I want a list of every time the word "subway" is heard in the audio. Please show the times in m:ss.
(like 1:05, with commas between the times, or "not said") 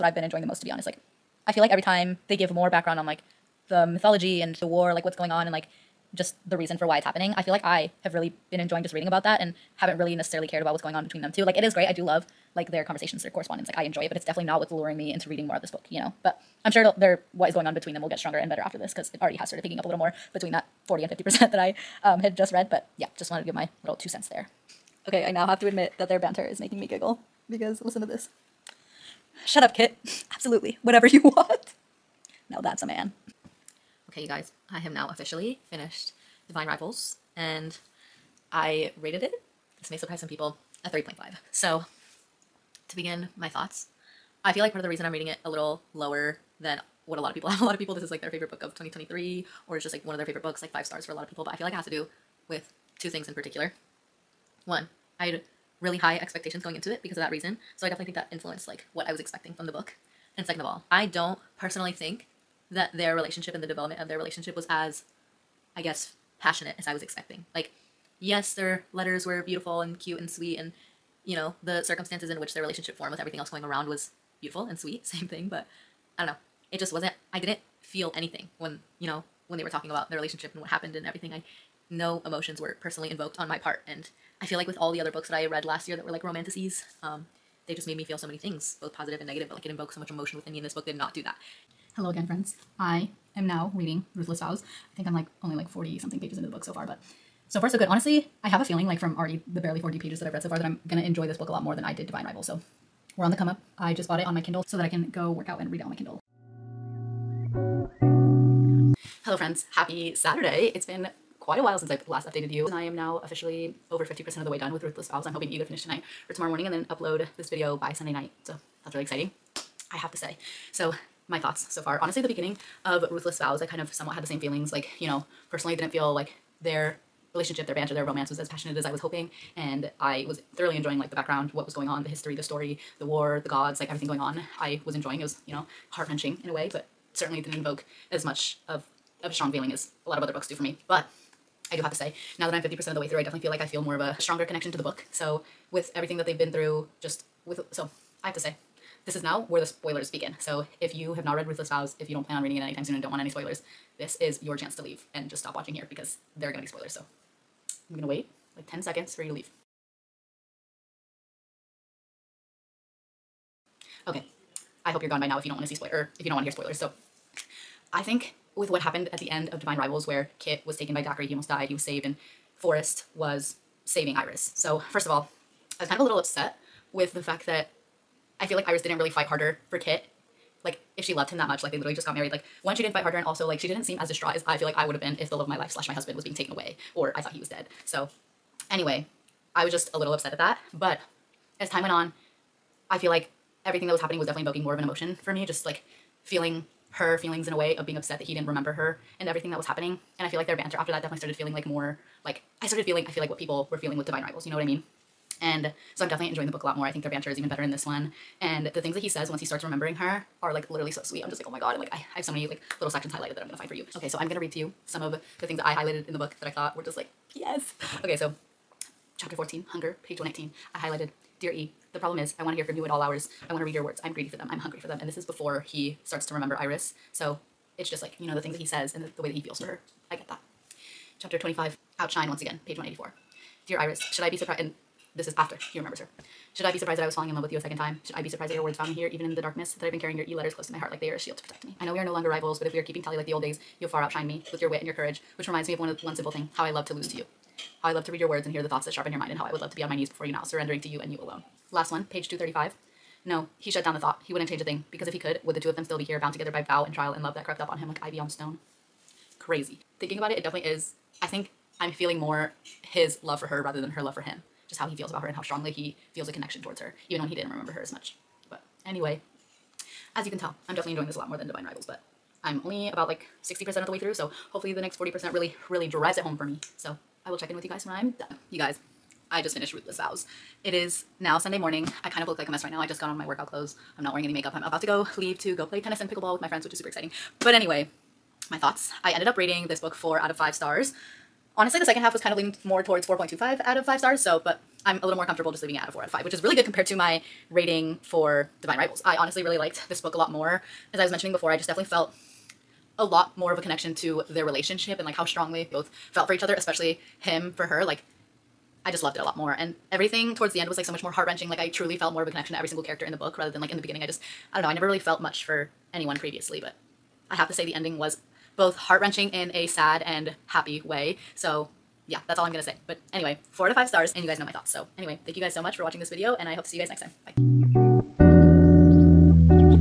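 not said.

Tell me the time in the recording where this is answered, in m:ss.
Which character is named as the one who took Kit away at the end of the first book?
2:51.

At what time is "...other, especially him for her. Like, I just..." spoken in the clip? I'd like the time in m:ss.
5:06.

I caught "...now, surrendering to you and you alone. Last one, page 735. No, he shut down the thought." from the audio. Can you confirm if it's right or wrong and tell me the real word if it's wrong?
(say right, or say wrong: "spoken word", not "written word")
wrong: "235", not "735".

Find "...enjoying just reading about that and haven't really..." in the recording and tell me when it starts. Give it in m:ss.
0:08.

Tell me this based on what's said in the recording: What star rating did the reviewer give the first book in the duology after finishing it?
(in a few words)
3.5.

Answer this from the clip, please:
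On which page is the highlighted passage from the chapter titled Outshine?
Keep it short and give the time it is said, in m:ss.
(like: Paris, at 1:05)
184, at 3:52.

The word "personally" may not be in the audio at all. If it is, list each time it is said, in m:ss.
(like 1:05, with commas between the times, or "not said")
1:01, 1:22, 2:05.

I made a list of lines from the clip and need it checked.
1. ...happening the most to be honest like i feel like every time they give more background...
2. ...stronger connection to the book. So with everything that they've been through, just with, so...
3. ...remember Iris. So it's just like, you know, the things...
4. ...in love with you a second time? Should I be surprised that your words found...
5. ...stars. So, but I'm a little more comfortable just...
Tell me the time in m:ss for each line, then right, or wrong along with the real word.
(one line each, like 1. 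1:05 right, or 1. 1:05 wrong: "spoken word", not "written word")
1. 0:00 wrong: "enjoying", not "happening"
2. 2:24 right
3. 3:46 right
4. 3:57 right
5. 4:53 right.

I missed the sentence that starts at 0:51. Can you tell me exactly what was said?
But I feel like it has to do with two things in particular.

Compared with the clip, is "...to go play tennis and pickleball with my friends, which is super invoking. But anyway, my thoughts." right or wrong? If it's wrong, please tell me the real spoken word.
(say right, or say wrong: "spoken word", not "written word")
wrong: "exciting", not "invoking".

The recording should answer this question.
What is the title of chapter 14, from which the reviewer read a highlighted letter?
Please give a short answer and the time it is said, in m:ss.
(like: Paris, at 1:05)
Hunger, at 3:39.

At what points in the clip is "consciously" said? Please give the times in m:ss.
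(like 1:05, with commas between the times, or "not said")
not said.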